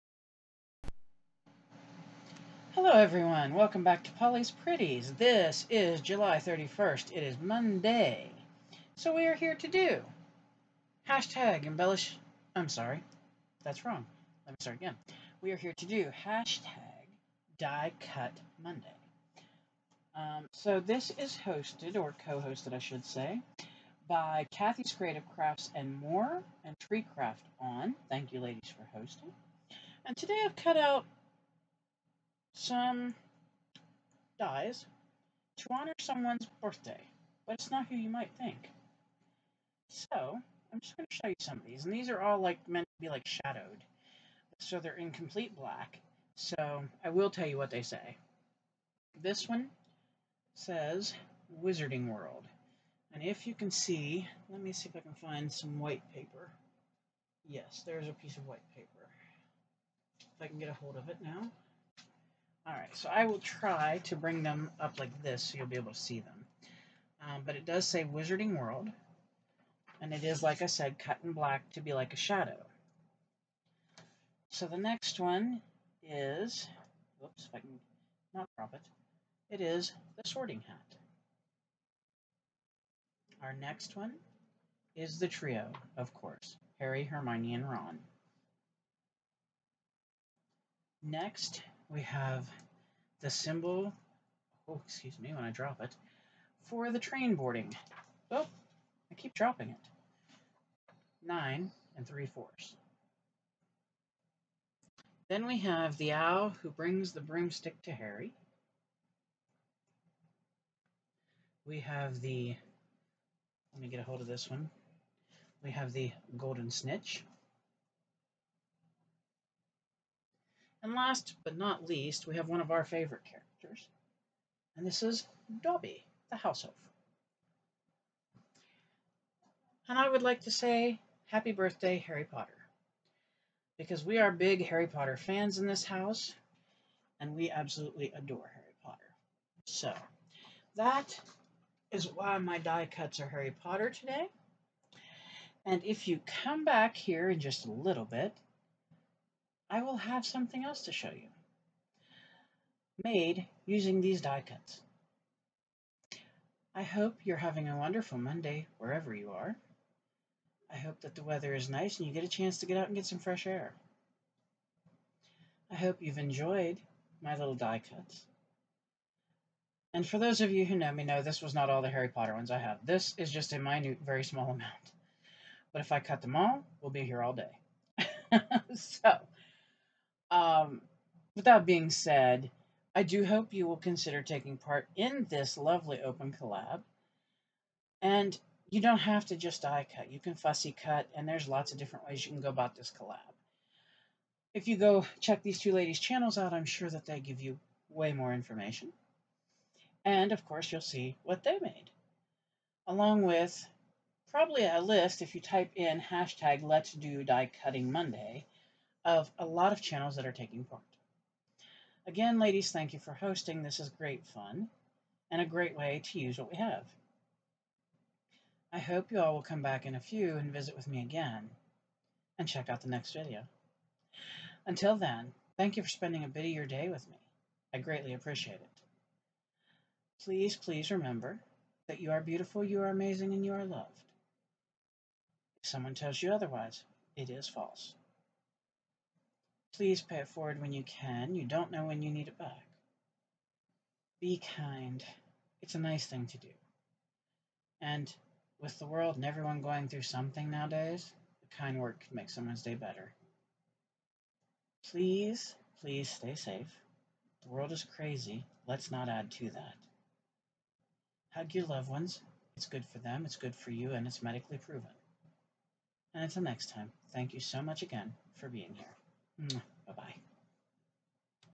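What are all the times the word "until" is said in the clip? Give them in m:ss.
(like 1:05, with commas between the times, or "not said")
3:44, 4:26.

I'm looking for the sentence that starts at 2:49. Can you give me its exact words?
And for those of you who know me, know this was not all the Harry Potter ones I have.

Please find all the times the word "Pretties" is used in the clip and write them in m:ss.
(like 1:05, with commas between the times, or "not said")
0:04.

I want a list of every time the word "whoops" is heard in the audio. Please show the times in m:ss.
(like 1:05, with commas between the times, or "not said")
1:17.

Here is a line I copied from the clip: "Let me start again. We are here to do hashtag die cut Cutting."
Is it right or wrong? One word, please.
wrong.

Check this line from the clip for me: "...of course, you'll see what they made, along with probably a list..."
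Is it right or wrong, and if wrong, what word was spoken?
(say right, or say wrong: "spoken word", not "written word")
right.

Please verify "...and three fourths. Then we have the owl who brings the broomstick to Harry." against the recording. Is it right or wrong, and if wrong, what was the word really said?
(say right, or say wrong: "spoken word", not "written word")
right.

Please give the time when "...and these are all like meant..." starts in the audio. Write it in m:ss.
0:41.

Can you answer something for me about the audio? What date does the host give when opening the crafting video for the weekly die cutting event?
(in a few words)
July 31st.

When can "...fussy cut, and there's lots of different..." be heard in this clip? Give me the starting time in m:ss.
3:10.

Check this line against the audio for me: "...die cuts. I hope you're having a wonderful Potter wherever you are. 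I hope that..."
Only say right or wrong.
wrong.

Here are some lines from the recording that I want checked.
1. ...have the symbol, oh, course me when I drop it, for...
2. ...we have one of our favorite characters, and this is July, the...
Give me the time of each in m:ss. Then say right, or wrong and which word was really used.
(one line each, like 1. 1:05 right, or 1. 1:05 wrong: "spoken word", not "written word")
1. 1:32 wrong: "excuse", not "course"
2. 2:02 wrong: "Dobby", not "July".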